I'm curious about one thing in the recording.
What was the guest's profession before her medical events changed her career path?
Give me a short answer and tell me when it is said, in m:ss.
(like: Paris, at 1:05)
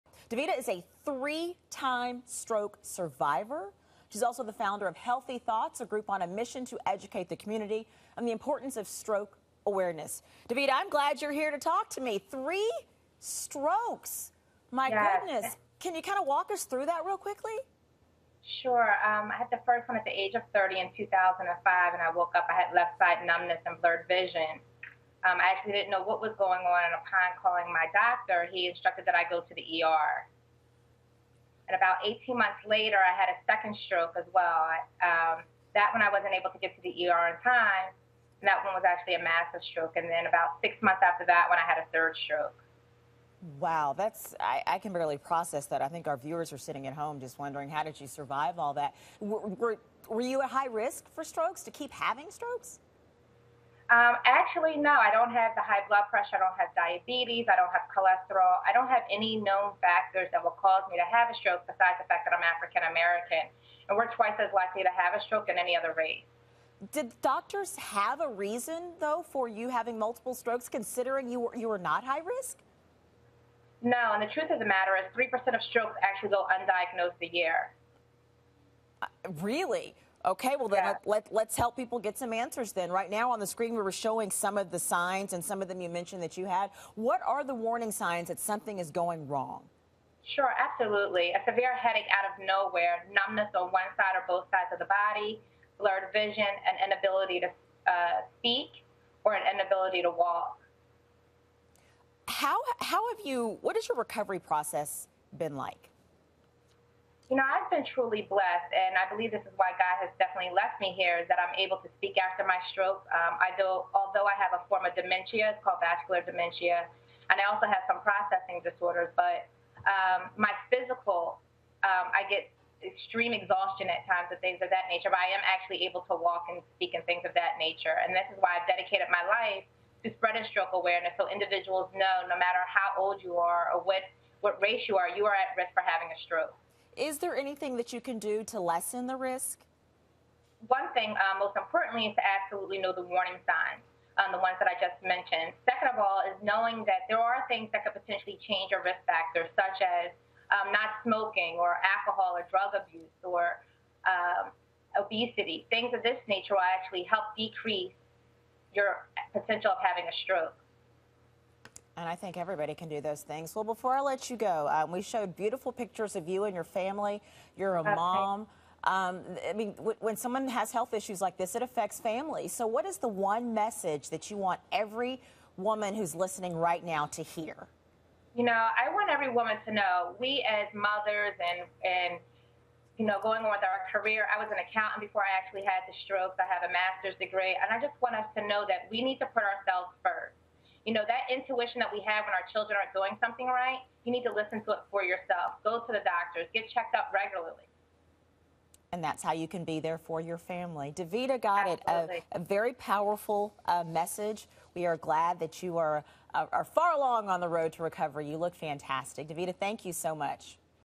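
Accountant, at 3:04.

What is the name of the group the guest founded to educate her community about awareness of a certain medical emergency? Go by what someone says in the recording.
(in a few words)
Healthy Thoughts.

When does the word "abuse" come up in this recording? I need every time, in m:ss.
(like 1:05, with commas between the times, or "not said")
2:32.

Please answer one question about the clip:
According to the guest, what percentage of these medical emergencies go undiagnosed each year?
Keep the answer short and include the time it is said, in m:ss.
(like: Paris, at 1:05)
3%, at 1:15.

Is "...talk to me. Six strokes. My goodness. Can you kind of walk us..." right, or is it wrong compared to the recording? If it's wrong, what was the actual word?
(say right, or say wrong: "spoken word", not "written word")
wrong: "Three", not "Six".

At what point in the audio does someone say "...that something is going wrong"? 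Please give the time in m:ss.
1:28.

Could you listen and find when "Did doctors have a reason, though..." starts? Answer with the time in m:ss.
1:06.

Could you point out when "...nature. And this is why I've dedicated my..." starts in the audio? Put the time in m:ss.
2:07.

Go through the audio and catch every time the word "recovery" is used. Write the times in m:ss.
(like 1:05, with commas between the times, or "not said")
1:43, 3:27.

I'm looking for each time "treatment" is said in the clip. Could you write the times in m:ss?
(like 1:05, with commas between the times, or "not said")
not said.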